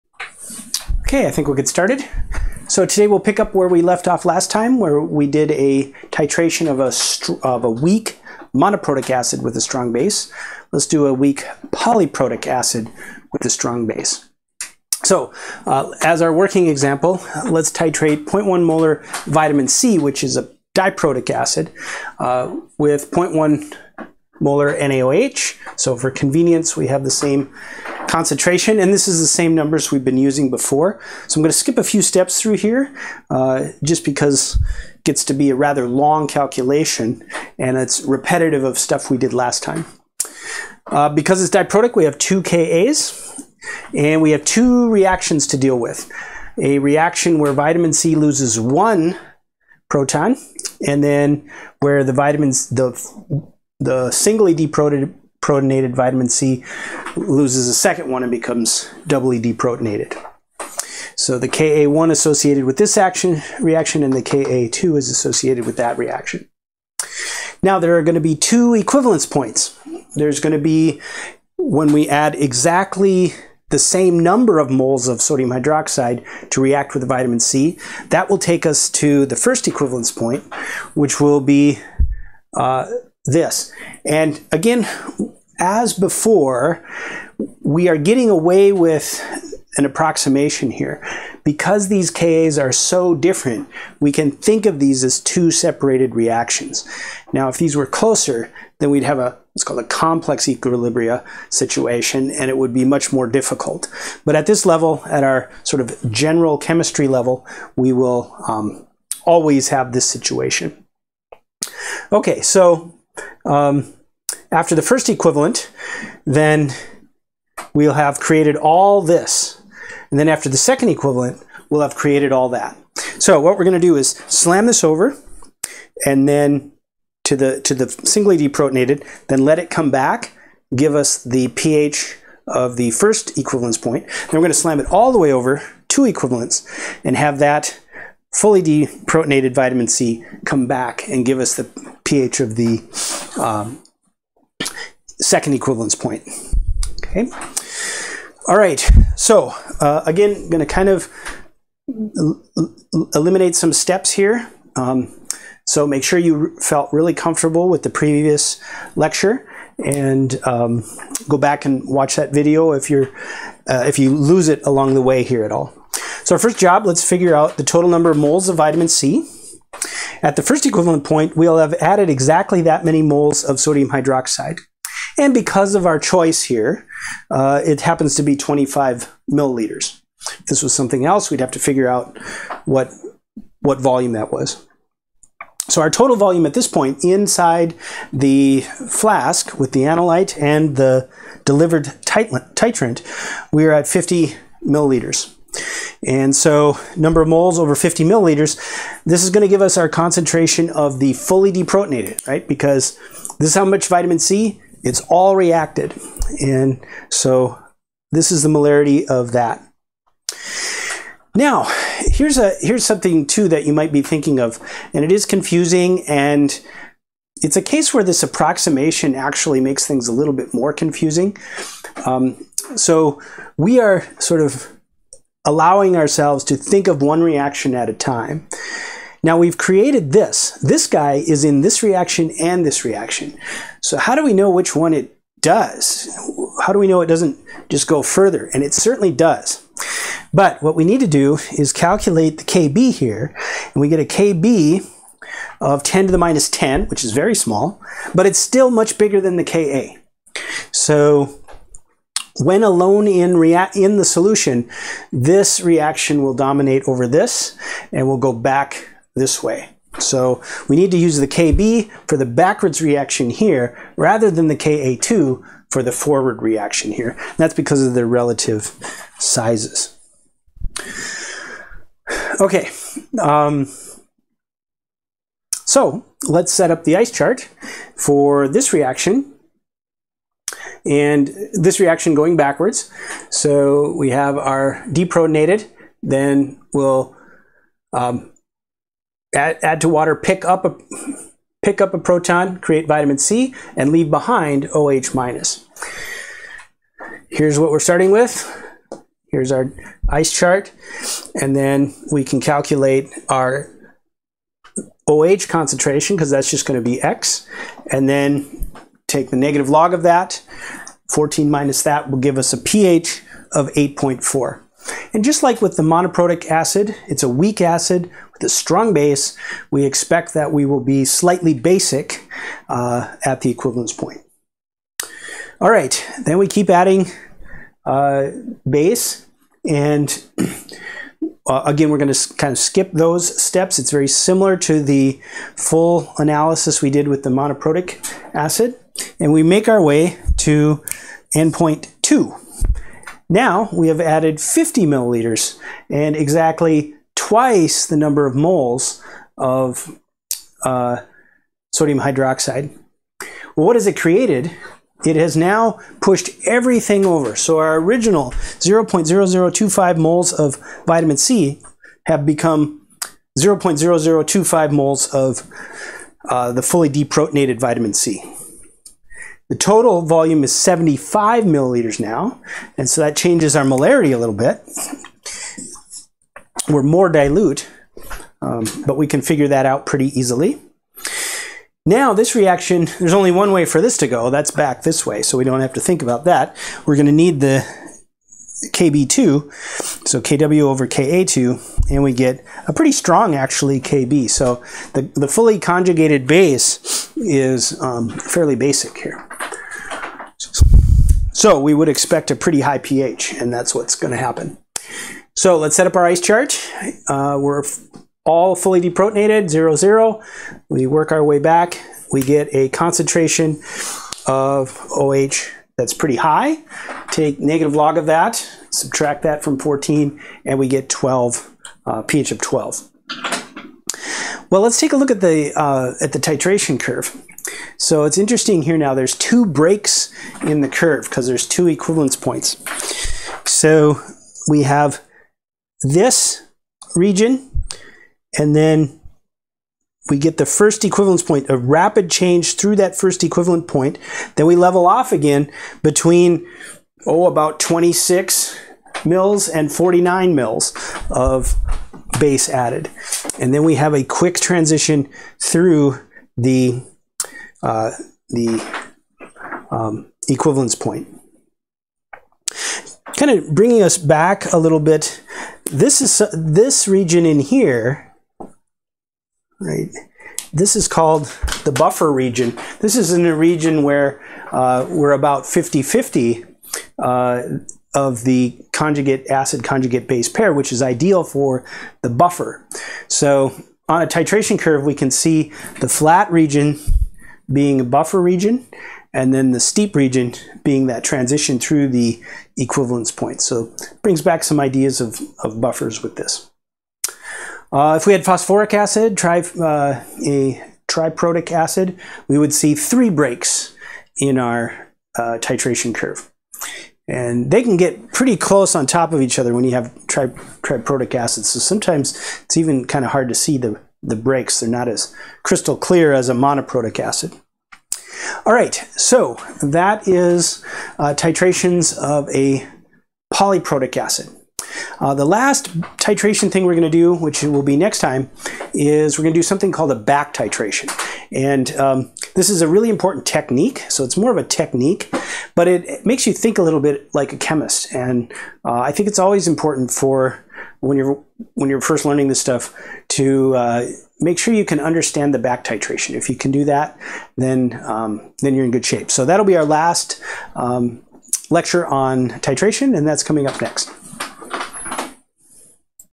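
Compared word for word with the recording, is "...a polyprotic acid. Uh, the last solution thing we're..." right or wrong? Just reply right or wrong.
wrong.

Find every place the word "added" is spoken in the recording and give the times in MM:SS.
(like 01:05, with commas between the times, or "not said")
02:51, 05:44, 07:32.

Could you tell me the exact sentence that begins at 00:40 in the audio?
Uh, because it's diprotic, we have two Kas, and we have two reactions to deal with.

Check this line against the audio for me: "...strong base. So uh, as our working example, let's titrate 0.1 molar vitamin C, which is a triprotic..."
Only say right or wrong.
wrong.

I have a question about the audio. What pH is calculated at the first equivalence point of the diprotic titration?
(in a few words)
8.4.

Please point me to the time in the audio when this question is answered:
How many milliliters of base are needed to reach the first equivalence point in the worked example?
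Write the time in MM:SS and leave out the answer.
02:58.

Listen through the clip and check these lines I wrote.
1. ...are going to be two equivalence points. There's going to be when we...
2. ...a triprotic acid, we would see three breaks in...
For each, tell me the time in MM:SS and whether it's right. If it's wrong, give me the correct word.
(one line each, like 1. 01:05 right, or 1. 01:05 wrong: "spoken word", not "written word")
1. 01:07 right
2. 08:20 right.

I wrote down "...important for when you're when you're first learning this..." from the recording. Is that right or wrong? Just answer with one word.
right.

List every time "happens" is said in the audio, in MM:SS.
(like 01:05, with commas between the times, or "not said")
02:57, 06:44.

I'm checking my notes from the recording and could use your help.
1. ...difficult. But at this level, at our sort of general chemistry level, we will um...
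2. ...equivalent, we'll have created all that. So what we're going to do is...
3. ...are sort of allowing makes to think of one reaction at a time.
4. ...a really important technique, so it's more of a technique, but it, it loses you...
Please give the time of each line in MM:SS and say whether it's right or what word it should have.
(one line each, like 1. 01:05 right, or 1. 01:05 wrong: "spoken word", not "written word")
1. 01:43 right
2. 02:00 right
3. 03:43 wrong: "ourselves", not "makes"
4. 08:52 wrong: "makes", not "loses".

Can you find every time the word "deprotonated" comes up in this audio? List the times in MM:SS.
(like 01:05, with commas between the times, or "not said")
00:54, 00:59, 02:08, 02:18, 03:21, 04:44, 06:06, 06:48.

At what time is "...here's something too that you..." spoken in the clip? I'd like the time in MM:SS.
03:32.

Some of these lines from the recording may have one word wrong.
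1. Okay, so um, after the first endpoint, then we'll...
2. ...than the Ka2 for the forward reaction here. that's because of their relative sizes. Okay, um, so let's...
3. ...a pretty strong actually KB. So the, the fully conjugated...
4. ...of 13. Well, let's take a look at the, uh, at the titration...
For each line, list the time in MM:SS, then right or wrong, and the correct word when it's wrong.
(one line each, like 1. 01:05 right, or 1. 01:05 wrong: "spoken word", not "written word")
1. 01:52 wrong: "equivalent", not "endpoint"
2. 04:24 right
3. 06:32 right
4. 07:02 wrong: "12", not "13".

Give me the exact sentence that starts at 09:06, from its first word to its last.
If you can do that, then, um, then you're in good shape.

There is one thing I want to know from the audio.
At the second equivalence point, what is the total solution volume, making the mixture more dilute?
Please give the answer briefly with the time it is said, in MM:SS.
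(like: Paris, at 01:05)
75 milliliters, at 06:10.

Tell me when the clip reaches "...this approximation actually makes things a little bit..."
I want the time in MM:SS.
03:38.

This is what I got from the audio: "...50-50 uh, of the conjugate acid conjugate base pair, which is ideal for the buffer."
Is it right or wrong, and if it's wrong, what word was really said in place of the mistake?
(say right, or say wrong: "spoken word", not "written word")
right.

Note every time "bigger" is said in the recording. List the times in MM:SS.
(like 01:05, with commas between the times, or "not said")
04:08.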